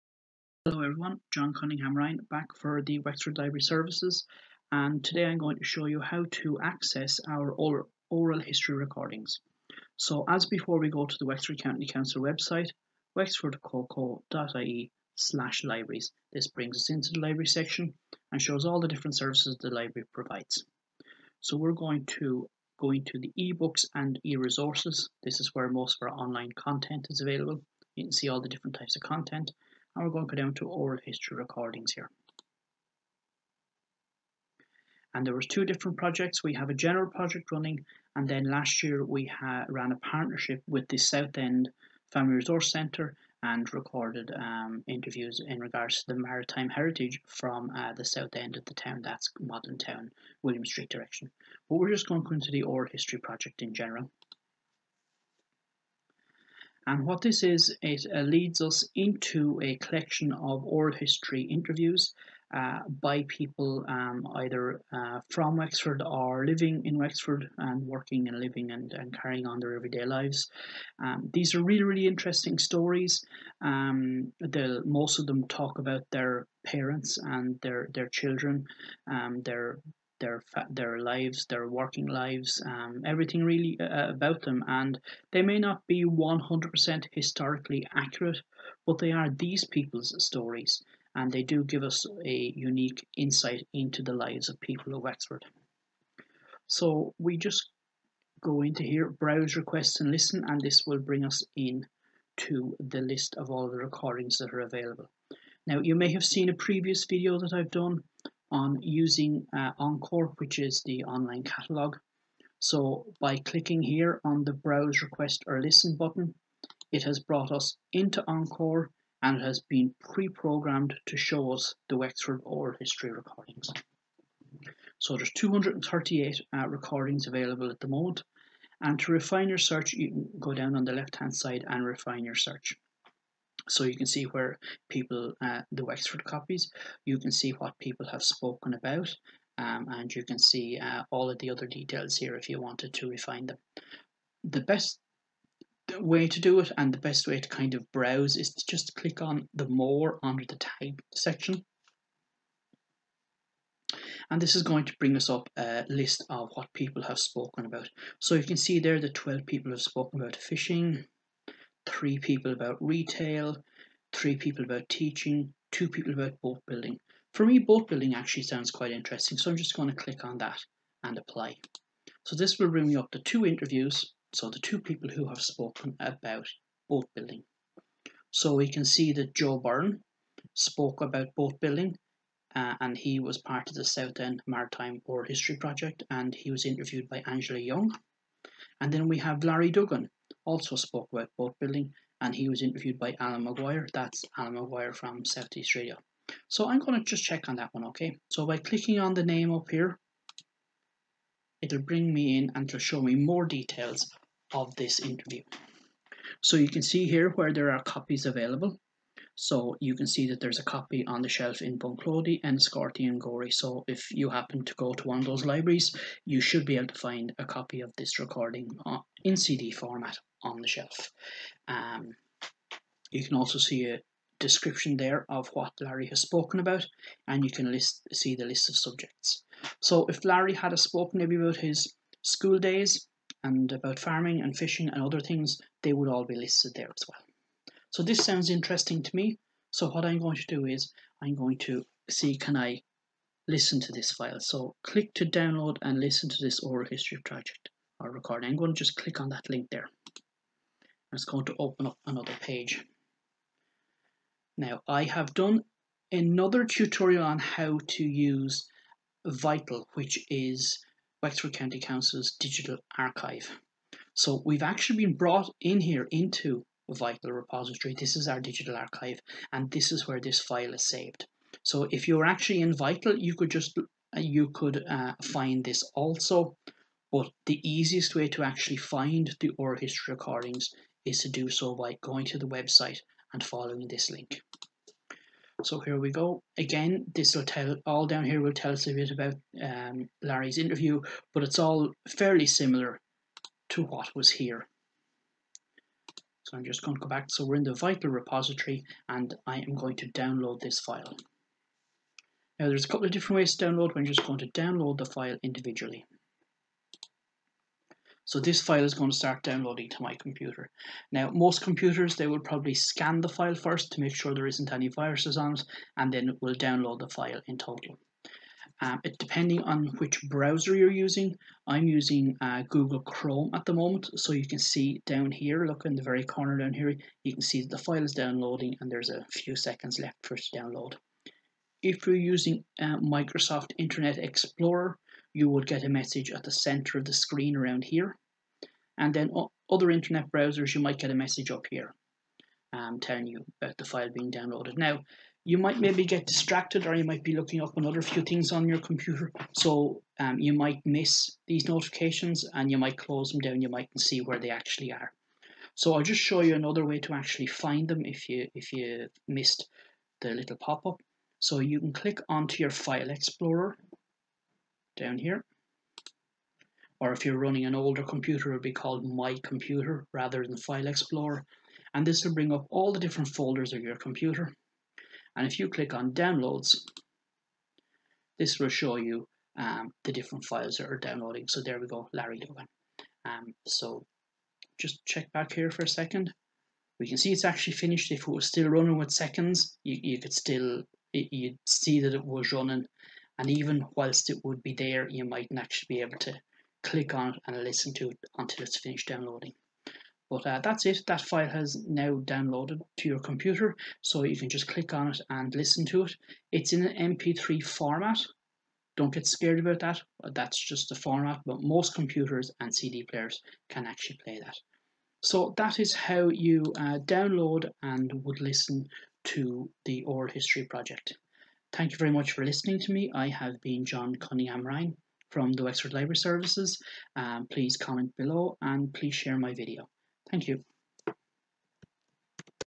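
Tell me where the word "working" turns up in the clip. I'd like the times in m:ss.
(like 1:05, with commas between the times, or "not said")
1:07, 1:21.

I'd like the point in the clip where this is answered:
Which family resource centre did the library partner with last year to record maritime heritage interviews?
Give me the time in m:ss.
0:40.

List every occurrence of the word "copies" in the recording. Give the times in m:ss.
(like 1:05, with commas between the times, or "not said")
2:16, 3:27.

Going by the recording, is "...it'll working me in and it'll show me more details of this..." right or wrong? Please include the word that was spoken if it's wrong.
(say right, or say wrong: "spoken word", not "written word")
wrong: "bring", not "working".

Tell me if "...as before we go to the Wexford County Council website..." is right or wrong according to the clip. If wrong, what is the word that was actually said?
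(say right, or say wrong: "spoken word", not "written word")
right.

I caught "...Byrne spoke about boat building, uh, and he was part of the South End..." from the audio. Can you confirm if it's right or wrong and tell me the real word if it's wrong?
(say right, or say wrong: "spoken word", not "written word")
right.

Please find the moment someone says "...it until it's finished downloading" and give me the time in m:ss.
6:38.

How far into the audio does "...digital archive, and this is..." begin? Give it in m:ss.
4:28.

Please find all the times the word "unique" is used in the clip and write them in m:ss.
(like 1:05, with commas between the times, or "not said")
1:32.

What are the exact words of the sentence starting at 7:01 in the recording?
Thank you very much for listening to me.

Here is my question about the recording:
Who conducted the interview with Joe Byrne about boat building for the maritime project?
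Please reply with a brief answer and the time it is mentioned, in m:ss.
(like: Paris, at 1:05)
Angela Young, at 3:07.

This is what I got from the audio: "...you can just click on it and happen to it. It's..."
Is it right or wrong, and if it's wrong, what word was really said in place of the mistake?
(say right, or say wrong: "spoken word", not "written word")
wrong: "listen", not "happen".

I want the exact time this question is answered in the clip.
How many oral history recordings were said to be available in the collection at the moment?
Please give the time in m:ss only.
2:05.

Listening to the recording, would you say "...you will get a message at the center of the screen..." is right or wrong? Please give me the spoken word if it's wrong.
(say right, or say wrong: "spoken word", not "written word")
right.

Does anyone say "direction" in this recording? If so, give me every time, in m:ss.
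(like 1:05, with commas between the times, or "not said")
0:50.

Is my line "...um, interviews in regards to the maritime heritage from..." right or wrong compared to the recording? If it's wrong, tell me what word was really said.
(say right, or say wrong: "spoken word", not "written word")
right.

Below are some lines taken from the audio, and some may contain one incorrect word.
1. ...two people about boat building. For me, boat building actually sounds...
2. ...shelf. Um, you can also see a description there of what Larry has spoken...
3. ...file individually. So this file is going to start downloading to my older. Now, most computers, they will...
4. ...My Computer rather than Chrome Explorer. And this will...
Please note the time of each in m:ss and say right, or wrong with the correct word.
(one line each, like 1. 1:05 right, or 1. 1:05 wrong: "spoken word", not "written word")
1. 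2:45 right
2. 3:40 right
3. 5:05 wrong: "computer", not "older"
4. 6:09 wrong: "File", not "Chrome".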